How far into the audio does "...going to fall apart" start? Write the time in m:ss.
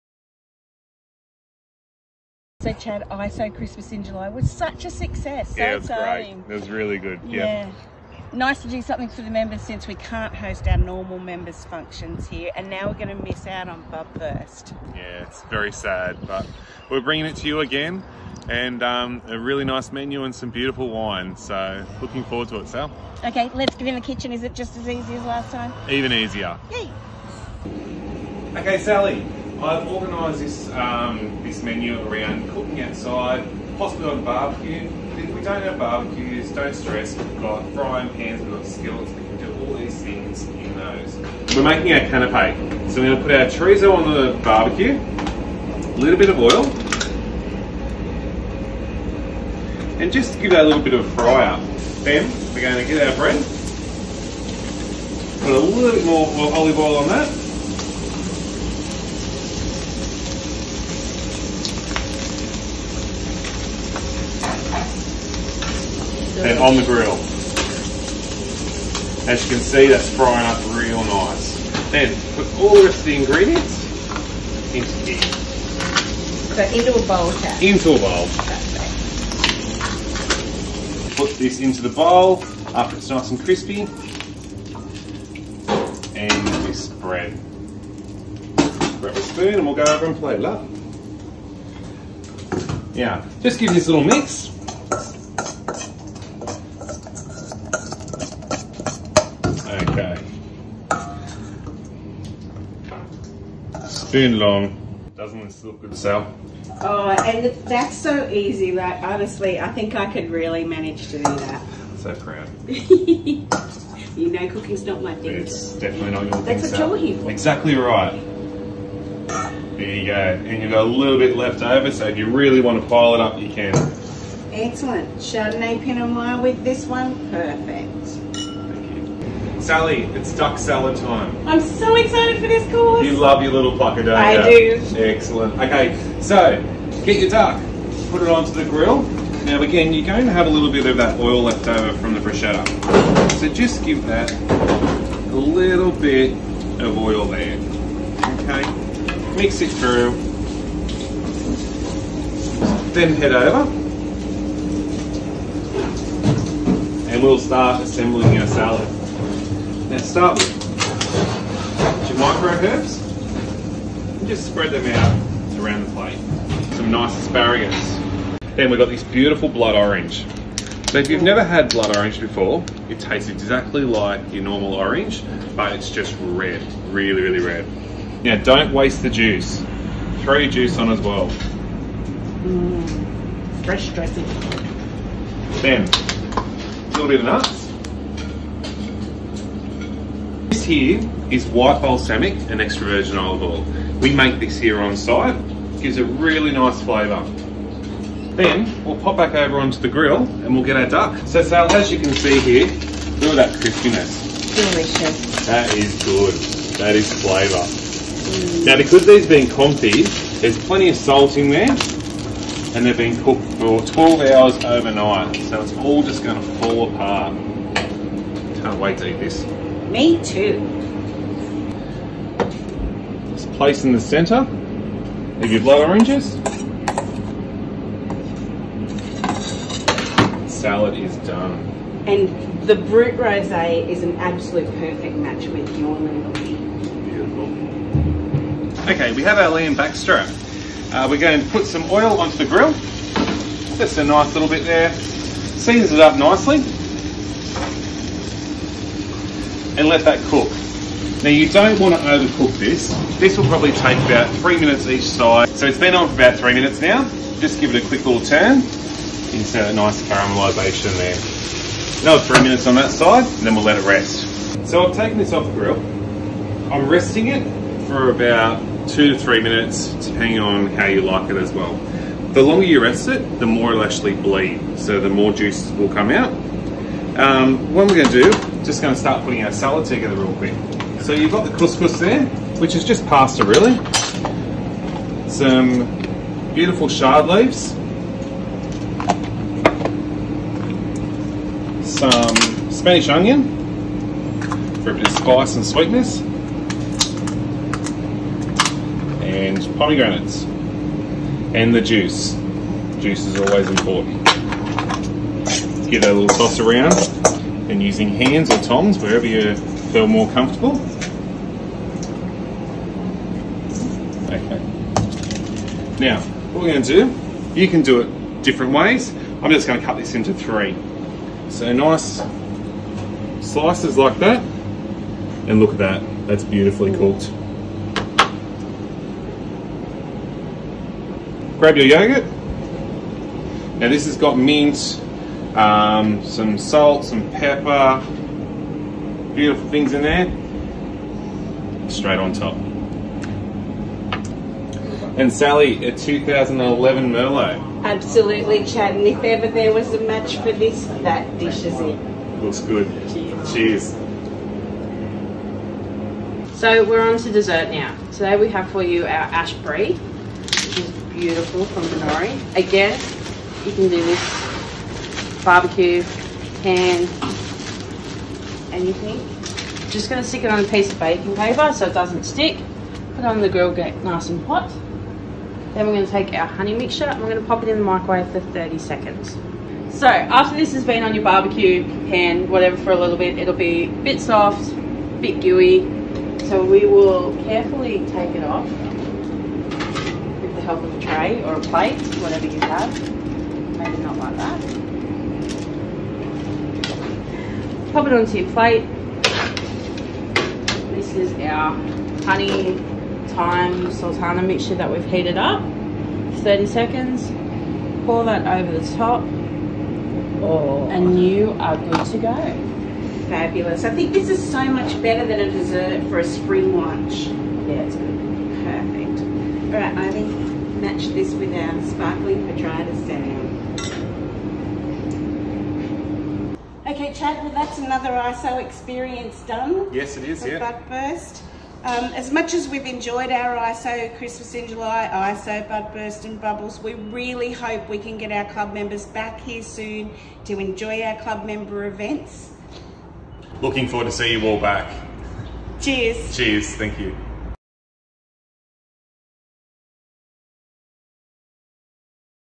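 3:36.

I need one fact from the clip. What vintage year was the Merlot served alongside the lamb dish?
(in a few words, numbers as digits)
2011.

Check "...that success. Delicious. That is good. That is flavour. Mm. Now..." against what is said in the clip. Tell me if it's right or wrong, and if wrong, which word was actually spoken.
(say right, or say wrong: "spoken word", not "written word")
wrong: "crispiness", not "success".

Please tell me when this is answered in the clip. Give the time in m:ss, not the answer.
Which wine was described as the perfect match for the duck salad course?
3:52.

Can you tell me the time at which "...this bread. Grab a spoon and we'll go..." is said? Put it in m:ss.
1:26.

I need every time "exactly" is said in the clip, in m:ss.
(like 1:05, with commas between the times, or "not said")
1:57, 2:53.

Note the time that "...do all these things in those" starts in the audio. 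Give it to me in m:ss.
0:39.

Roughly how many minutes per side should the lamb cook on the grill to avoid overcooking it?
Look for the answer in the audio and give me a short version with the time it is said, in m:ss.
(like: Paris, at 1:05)
3, at 4:14.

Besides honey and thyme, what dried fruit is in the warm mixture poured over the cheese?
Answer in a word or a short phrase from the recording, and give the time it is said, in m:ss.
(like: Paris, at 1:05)
Sultana, at 6:43.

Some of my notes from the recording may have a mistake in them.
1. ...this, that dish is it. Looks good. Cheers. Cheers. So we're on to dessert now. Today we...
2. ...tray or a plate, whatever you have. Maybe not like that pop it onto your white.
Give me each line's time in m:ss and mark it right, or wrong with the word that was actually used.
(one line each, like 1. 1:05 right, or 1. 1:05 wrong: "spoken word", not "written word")
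1. 5:50 right
2. 6:31 wrong: "plate", not "white".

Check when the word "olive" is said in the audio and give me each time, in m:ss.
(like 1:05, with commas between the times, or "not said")
0:56, 3:13.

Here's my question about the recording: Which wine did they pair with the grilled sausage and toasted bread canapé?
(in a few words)
Chardonnay Pinot Noir.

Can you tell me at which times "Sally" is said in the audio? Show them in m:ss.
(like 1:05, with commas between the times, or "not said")
0:28, 2:09, 5:45.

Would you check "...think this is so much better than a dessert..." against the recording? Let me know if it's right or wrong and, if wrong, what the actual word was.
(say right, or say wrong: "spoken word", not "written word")
right.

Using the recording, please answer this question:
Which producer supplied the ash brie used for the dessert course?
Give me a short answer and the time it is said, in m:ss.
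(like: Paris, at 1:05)
Binnorie, at 6:01.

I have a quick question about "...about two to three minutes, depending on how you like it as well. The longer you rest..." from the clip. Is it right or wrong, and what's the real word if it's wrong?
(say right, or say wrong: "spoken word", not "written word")
right.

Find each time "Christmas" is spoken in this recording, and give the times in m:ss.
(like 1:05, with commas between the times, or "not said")
0:03, 7:14.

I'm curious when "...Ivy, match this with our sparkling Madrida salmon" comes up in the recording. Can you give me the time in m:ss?
6:59.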